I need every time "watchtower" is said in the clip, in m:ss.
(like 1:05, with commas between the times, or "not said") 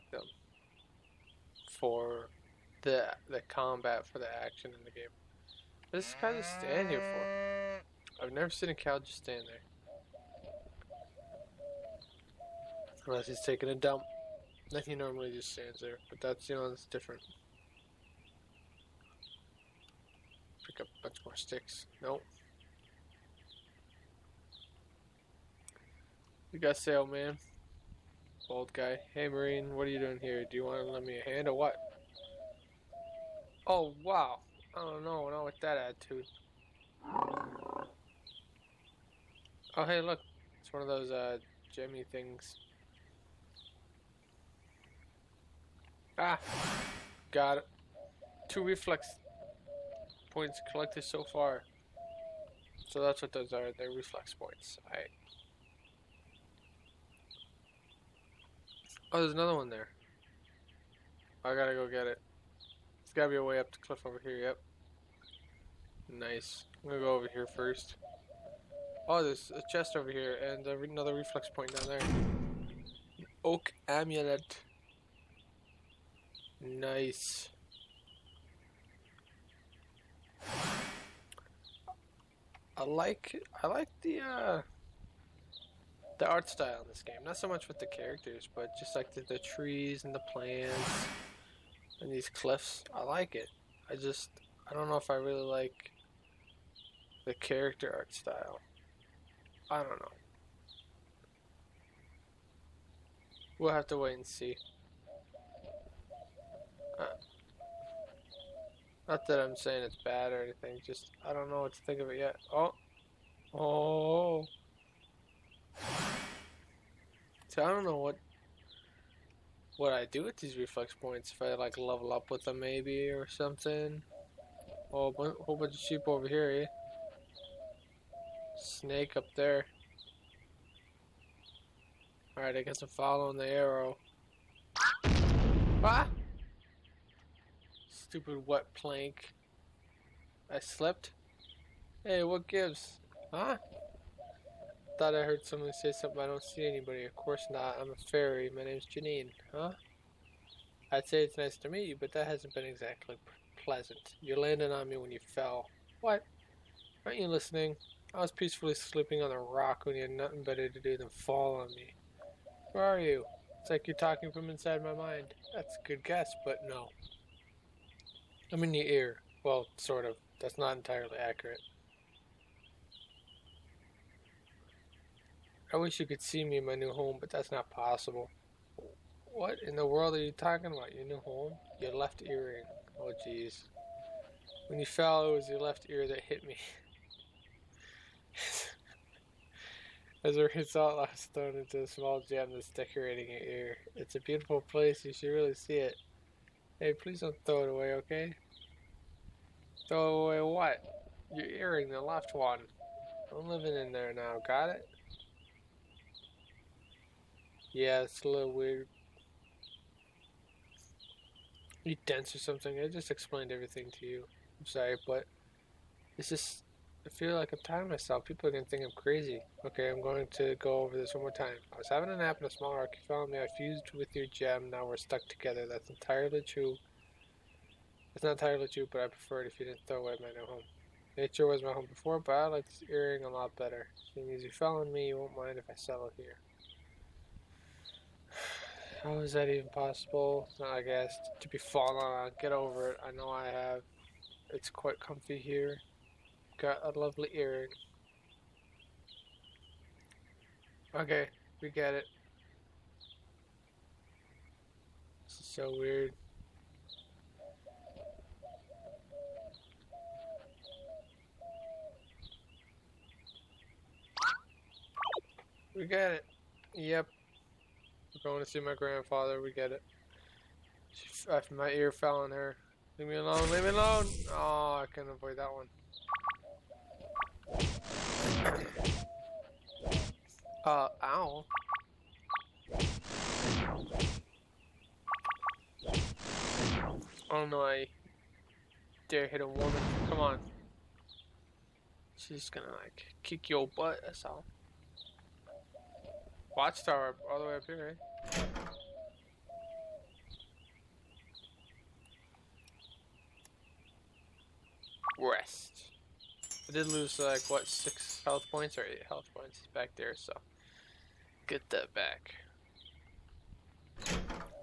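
4:56.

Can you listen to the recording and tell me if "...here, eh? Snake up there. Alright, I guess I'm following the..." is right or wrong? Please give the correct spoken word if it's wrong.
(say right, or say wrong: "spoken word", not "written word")
right.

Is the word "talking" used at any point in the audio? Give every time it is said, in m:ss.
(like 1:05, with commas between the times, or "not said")
2:43, 3:00.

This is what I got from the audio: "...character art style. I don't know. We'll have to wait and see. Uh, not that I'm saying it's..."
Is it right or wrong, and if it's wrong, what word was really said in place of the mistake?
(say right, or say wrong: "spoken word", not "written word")
right.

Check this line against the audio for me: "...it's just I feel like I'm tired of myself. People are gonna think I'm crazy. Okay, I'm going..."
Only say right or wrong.
right.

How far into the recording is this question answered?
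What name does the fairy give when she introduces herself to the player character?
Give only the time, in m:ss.
2:28.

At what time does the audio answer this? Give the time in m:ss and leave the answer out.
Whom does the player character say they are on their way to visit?
4:28.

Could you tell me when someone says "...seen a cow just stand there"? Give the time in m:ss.
0:08.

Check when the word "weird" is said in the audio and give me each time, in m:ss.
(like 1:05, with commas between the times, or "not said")
3:28, 4:15.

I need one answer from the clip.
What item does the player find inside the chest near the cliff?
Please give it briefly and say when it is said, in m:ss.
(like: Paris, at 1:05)
Oak amulet, at 1:13.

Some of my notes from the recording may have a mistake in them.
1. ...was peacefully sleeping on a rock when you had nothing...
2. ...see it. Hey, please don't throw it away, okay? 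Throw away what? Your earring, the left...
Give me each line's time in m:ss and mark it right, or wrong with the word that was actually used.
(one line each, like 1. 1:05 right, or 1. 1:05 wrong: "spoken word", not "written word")
1. 2:38 right
2. 3:15 right.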